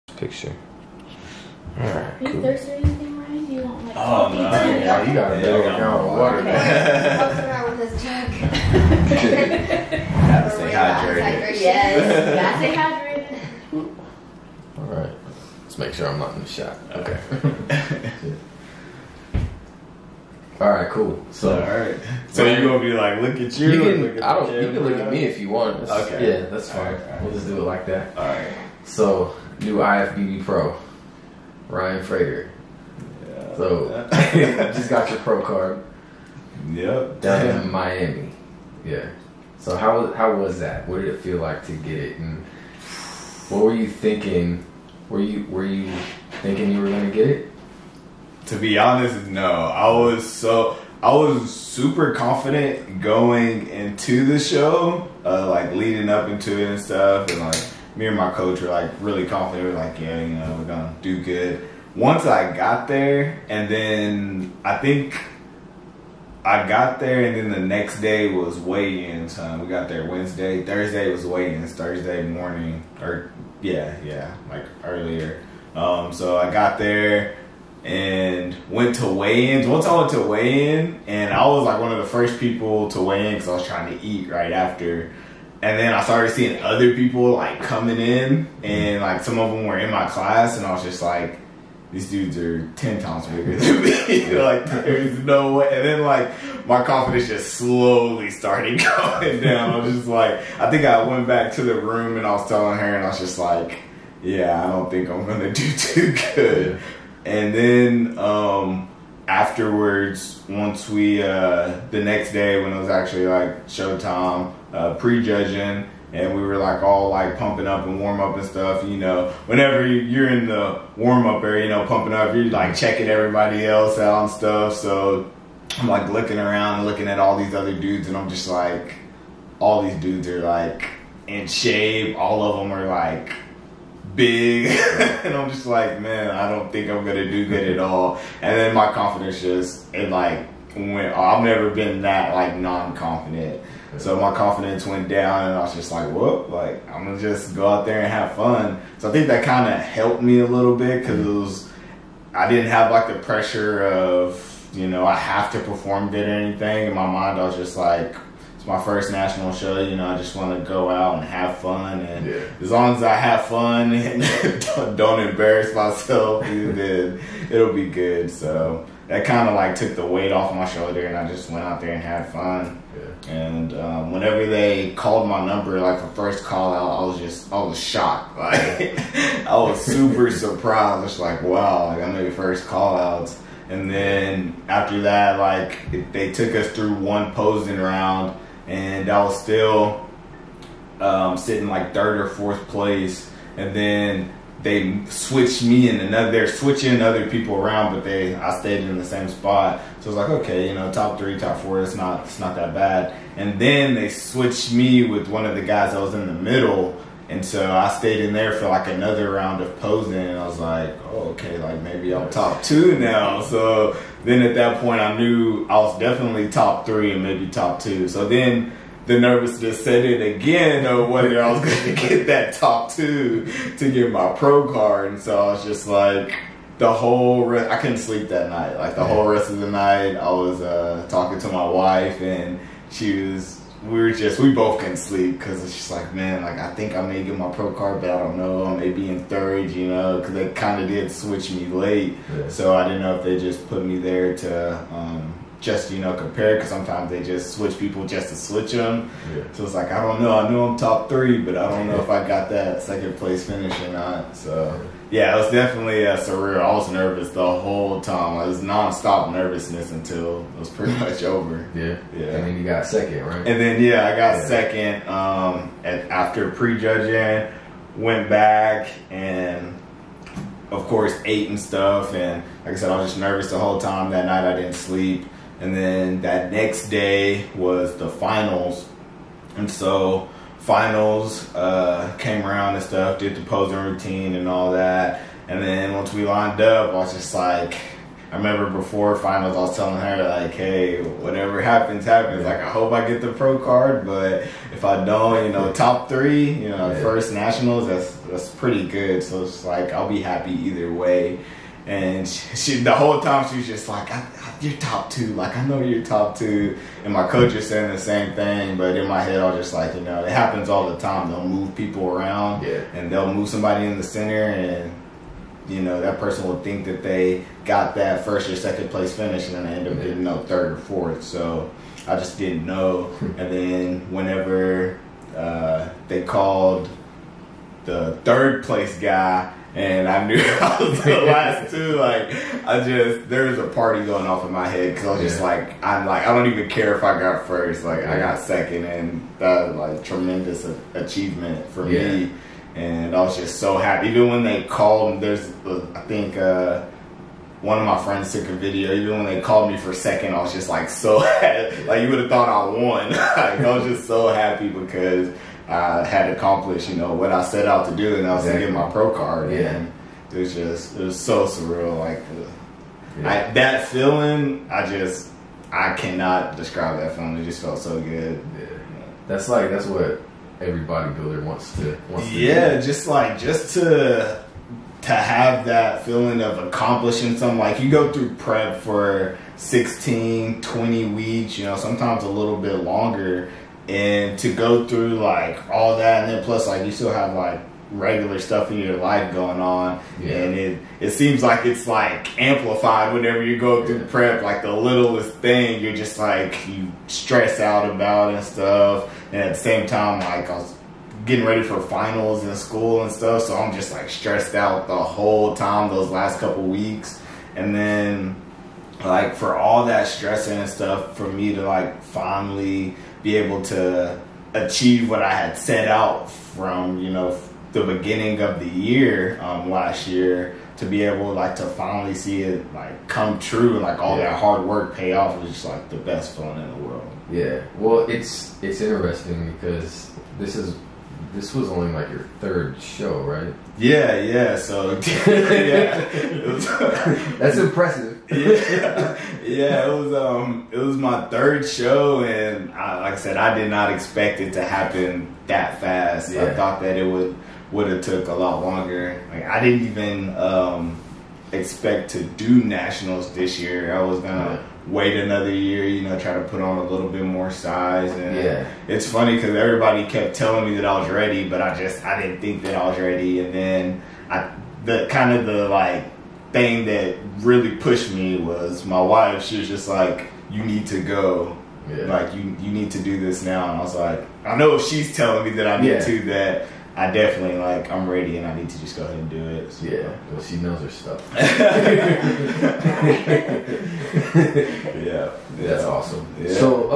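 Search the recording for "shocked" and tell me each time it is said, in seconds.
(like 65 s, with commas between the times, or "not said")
177 s.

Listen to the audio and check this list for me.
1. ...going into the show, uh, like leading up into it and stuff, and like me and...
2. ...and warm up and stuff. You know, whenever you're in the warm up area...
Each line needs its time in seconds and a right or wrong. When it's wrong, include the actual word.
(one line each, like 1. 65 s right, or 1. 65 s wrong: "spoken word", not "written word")
1. 53 s right
2. 117 s right.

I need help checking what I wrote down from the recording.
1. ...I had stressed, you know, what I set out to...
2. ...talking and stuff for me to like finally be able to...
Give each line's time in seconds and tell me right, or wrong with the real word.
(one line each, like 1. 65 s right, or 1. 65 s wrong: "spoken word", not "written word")
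1. 355 s wrong: "accomplished", not "stressed"
2. 410 s wrong: "stressing", not "talking".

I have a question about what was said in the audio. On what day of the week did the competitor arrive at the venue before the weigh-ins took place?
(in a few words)
Wednesday.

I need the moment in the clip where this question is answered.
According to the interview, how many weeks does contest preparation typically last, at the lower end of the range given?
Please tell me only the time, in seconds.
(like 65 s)
379 s.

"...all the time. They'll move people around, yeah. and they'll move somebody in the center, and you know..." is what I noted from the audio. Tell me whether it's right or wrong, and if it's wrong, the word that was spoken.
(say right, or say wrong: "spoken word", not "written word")
right.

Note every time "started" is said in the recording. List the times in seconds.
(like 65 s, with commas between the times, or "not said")
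86 s, 98 s.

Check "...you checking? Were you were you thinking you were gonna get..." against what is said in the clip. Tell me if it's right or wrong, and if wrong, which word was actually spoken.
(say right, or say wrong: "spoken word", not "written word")
wrong: "thinking", not "checking".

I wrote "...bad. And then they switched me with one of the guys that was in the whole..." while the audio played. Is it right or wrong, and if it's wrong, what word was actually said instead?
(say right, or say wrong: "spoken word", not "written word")
wrong: "middle", not "whole".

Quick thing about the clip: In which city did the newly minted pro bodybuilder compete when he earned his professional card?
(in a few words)
Miami.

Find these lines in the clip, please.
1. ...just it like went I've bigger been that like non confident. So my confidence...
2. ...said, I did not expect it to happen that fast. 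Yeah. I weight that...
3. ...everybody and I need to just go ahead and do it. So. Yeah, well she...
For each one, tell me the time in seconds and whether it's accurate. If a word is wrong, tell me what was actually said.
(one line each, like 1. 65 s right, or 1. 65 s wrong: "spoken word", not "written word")
1. 139 s wrong: "never", not "bigger"
2. 443 s wrong: "thought", not "weight"
3. 478 s wrong: "ready", not "everybody".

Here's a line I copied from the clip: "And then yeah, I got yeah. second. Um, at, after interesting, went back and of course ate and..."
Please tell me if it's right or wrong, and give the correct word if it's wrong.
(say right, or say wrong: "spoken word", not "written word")
wrong: "prejudging", not "interesting".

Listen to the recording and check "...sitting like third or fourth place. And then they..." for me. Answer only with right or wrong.
right.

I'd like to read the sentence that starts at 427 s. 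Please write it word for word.
Yeah, well, it's it's interesting because this is this was only like your third show, right?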